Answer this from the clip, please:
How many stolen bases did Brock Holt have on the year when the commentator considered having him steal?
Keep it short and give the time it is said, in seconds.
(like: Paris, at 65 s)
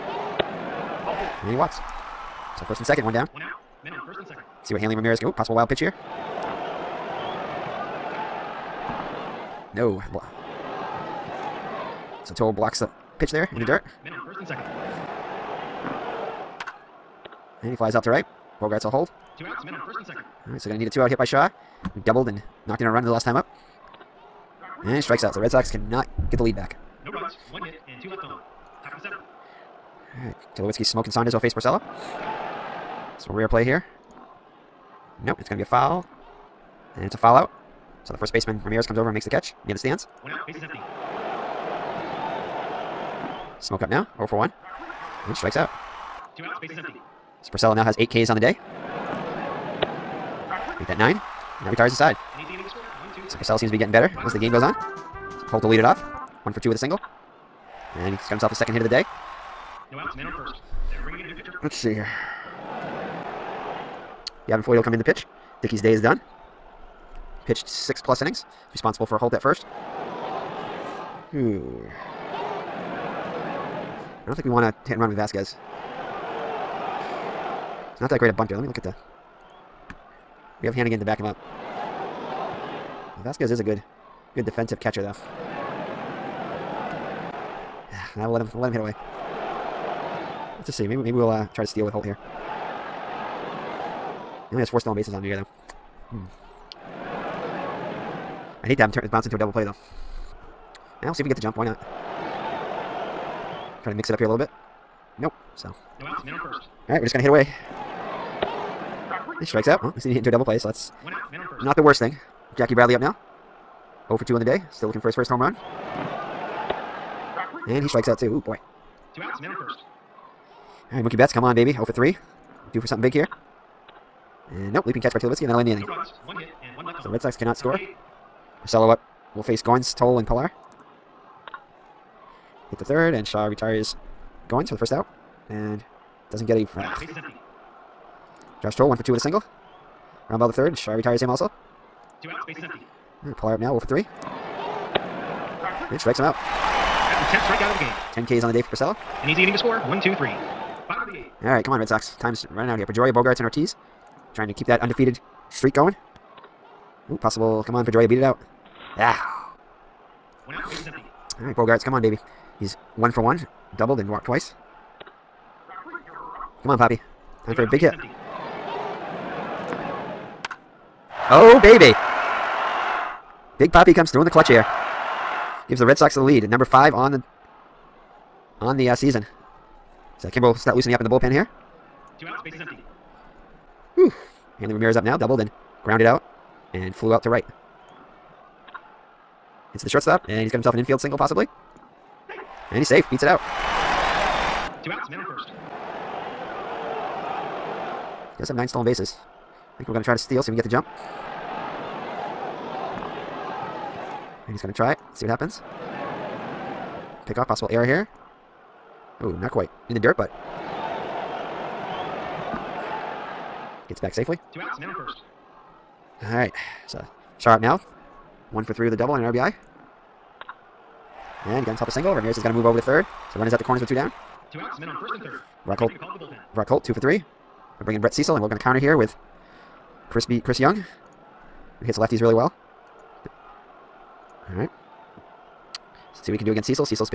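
4, at 94 s.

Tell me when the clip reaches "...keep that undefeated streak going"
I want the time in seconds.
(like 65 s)
154 s.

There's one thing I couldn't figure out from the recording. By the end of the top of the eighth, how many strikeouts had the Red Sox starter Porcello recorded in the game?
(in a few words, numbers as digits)
10.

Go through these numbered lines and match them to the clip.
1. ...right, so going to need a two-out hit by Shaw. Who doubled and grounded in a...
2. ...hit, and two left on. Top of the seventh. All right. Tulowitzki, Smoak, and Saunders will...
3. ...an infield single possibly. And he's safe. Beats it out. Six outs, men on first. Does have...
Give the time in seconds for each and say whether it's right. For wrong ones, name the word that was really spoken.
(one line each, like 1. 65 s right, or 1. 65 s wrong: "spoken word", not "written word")
1. 20 s wrong: "knocked", not "grounded"
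2. 27 s right
3. 190 s wrong: "Two", not "Six".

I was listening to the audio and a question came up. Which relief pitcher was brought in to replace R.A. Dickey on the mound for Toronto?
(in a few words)
Gavin Floyd.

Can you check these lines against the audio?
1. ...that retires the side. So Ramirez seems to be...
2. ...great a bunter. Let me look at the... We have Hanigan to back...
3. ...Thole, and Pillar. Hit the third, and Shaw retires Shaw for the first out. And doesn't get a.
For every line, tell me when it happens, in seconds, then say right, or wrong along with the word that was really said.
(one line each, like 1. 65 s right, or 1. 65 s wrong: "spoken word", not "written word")
1. 51 s wrong: "Porcello", not "Ramirez"
2. 78 s right
3. 129 s wrong: "Goins", not "Shaw".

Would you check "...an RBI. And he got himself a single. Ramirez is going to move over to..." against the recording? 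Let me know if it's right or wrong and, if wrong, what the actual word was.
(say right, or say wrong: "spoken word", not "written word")
right.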